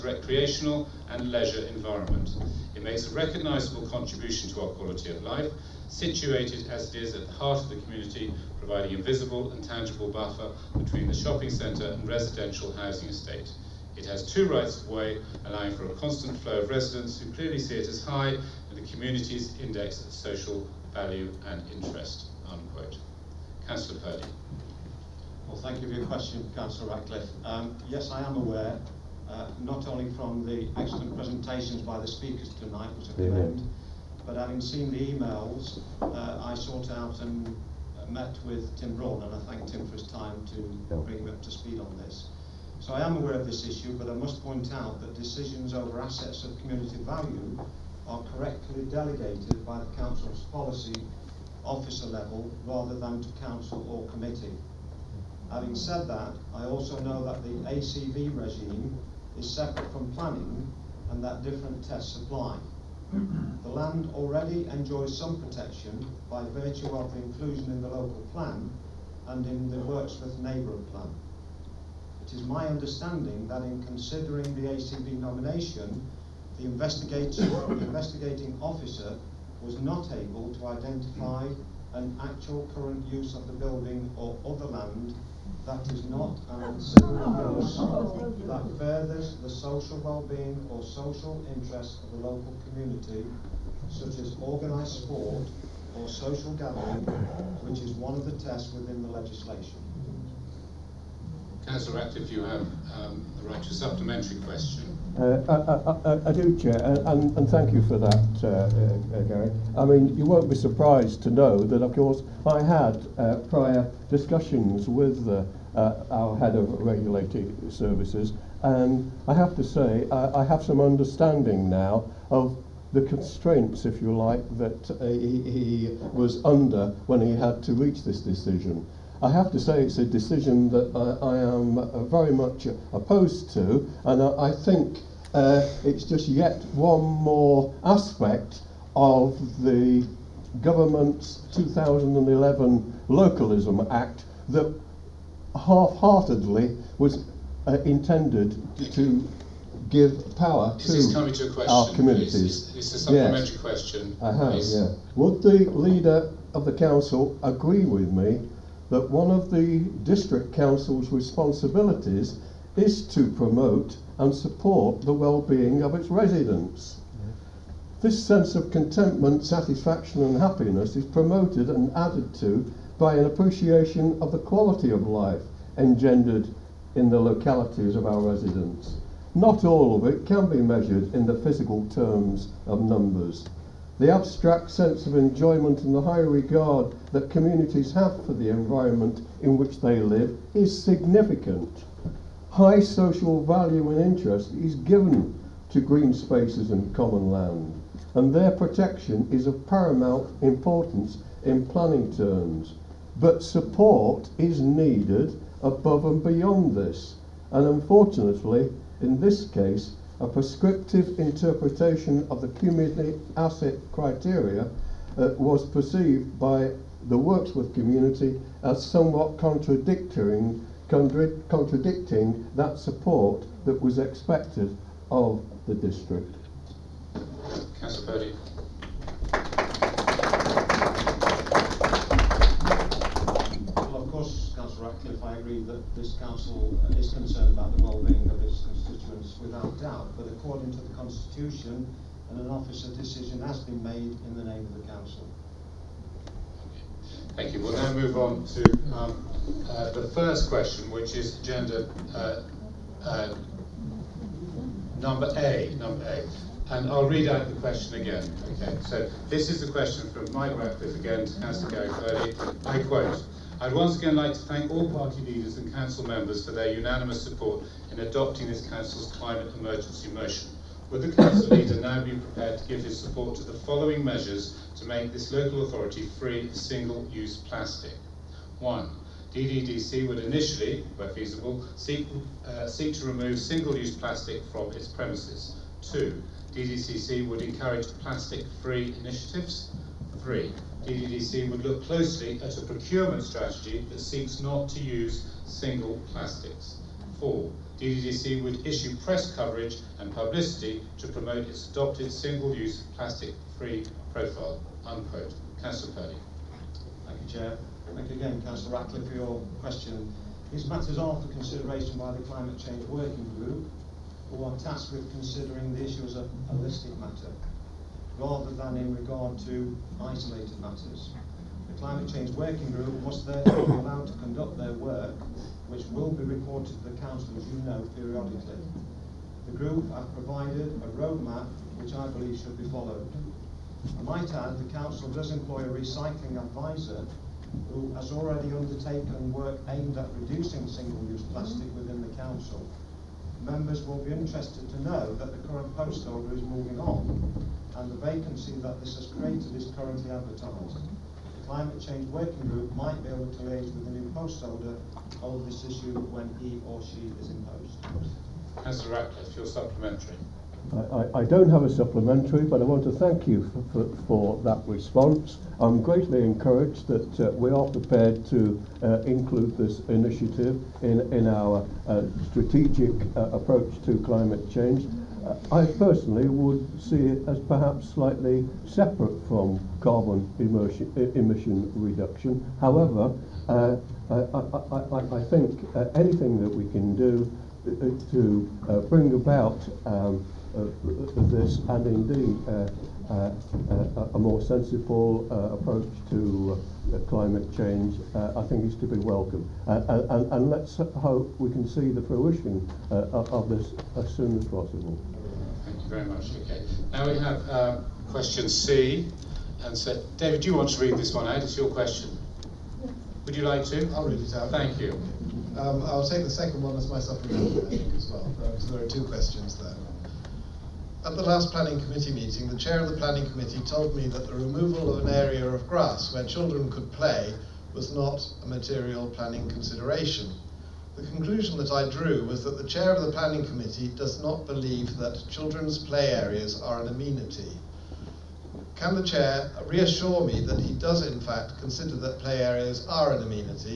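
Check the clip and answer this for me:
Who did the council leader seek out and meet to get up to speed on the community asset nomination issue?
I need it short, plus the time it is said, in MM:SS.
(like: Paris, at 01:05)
Tim Braund, at 00:38.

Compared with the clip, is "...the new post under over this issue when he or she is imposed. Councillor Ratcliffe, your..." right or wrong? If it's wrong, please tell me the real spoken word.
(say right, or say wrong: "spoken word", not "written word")
wrong: "holder", not "under".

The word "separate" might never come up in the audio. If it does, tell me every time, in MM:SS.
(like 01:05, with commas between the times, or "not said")
00:59, 06:18.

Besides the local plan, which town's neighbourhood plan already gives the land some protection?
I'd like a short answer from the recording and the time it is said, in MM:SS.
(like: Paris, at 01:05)
Worksworth, at 01:09.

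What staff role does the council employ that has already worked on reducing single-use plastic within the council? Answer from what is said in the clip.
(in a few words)
recycling advisor.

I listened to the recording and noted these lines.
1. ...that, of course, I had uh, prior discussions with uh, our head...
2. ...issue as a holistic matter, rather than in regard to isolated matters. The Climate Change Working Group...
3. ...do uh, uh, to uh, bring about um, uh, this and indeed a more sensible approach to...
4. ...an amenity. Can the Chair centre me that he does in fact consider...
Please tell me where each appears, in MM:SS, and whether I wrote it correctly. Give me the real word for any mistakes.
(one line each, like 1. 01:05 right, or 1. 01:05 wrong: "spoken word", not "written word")
1. 01:51 right
2. 05:15 right
3. 06:26 right
4. 07:16 wrong: "reassure", not "centre".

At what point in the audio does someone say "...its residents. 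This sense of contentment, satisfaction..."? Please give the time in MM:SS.
02:45.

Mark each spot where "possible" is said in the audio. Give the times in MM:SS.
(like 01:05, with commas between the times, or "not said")
06:44.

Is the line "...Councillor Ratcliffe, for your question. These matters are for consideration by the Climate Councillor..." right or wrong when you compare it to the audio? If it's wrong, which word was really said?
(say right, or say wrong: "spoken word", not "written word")
wrong: "Change", not "Councillor".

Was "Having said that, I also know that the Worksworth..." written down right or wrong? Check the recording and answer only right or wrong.
wrong.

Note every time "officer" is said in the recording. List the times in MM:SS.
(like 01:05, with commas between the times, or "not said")
00:51, 01:18, 04:02.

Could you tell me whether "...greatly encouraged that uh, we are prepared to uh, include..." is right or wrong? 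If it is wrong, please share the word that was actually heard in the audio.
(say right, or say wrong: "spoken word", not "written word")
right.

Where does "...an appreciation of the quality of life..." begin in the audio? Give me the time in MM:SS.
02:53.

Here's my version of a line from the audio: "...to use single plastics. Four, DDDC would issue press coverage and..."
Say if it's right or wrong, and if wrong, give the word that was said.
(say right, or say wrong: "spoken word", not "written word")
right.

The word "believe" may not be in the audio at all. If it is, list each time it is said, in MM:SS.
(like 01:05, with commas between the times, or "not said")
05:32, 07:14.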